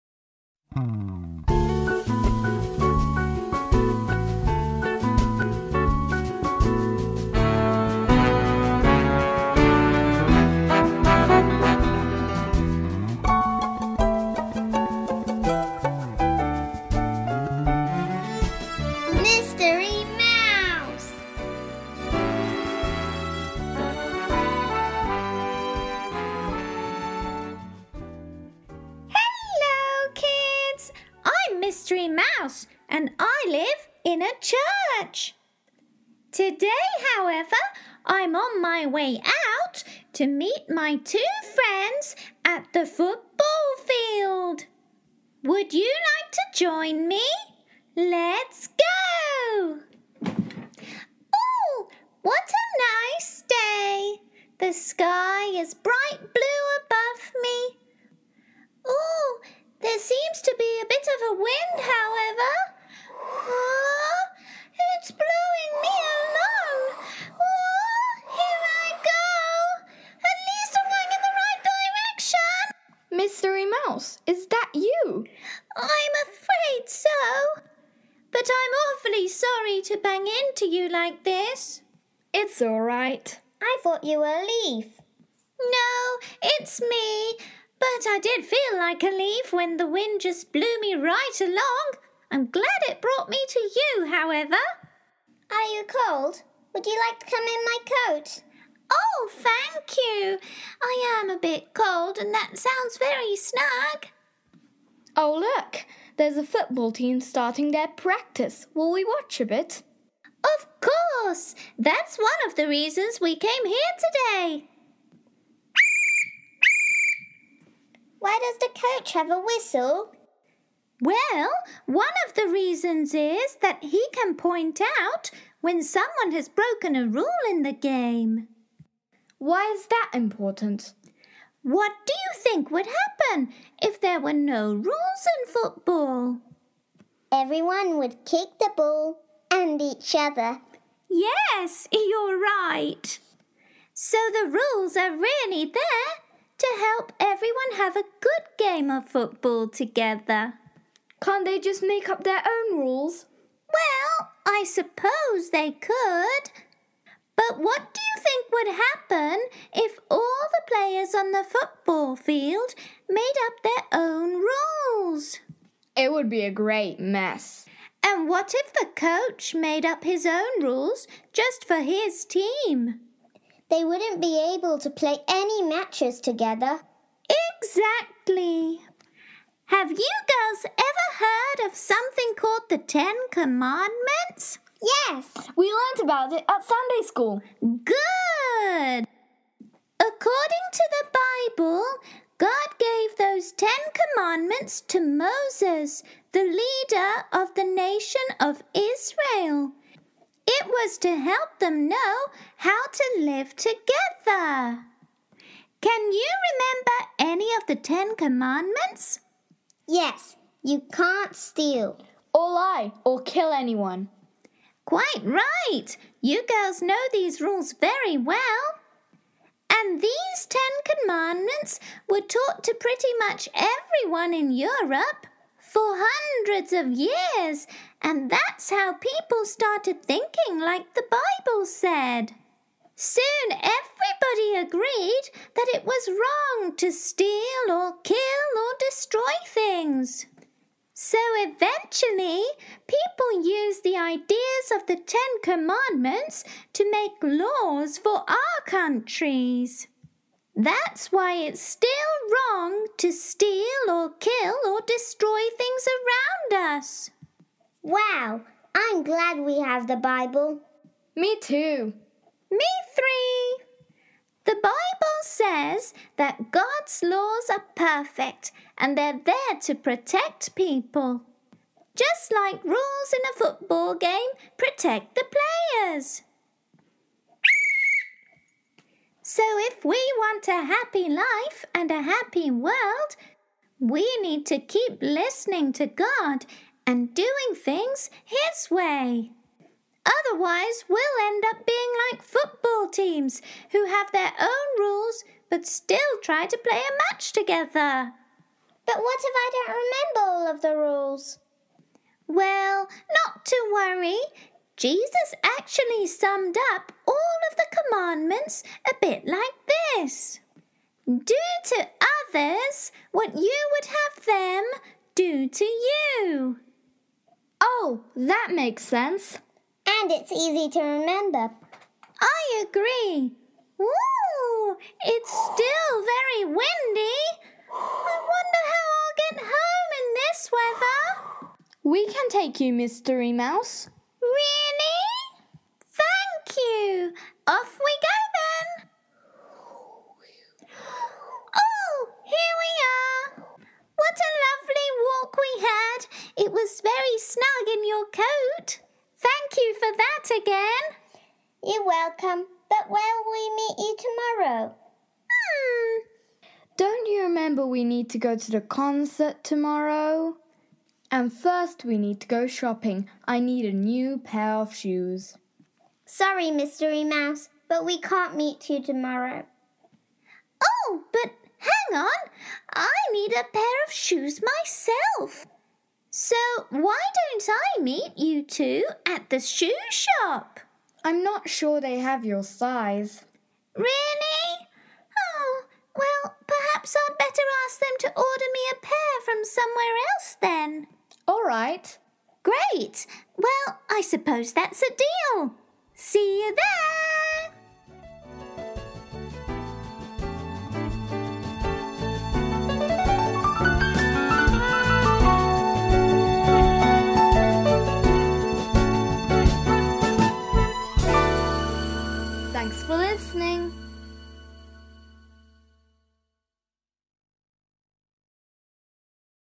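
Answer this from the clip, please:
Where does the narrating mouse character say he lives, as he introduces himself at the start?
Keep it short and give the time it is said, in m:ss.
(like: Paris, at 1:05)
A church, at 0:34.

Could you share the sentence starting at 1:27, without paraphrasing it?
But I did feel like a leaf when the wind just blew me right along.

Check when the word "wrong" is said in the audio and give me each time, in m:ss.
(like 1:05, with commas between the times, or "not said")
3:56, 4:12.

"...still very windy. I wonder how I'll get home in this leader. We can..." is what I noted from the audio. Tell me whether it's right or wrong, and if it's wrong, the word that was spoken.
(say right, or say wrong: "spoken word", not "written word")
wrong: "weather", not "leader".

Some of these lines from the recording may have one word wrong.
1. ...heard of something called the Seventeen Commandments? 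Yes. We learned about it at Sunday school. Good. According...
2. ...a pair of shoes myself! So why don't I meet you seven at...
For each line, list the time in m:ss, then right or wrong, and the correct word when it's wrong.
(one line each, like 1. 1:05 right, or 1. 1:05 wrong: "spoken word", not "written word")
1. 3:01 wrong: "Ten", not "Seventeen"
2. 6:13 wrong: "two", not "seven".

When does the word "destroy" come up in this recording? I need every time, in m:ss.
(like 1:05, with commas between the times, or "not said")
3:58, 4:14.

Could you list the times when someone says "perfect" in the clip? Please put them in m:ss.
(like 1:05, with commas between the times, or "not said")
4:27.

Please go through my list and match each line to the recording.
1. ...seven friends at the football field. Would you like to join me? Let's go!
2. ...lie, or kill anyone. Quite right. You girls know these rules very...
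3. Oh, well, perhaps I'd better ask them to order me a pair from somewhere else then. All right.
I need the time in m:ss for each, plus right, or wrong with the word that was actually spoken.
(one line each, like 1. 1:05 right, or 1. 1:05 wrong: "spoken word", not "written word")
1. 0:40 wrong: "two", not "seven"
2. 3:32 right
3. 6:25 right.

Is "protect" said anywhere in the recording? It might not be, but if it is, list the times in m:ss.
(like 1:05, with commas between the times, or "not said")
4:29, 4:34.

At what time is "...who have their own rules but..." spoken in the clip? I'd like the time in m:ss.
4:53.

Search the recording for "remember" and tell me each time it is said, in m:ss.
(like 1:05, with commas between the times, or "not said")
3:26, 4:59, 5:20, 5:57.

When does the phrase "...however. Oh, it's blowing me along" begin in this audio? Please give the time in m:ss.
1:01.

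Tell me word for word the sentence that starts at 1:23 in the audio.
I thought you were a leaf.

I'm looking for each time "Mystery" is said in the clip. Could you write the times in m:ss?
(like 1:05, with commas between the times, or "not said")
0:31, 1:13, 5:32, 6:06.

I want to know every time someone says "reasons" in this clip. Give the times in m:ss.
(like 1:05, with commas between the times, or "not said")
1:52, 2:02.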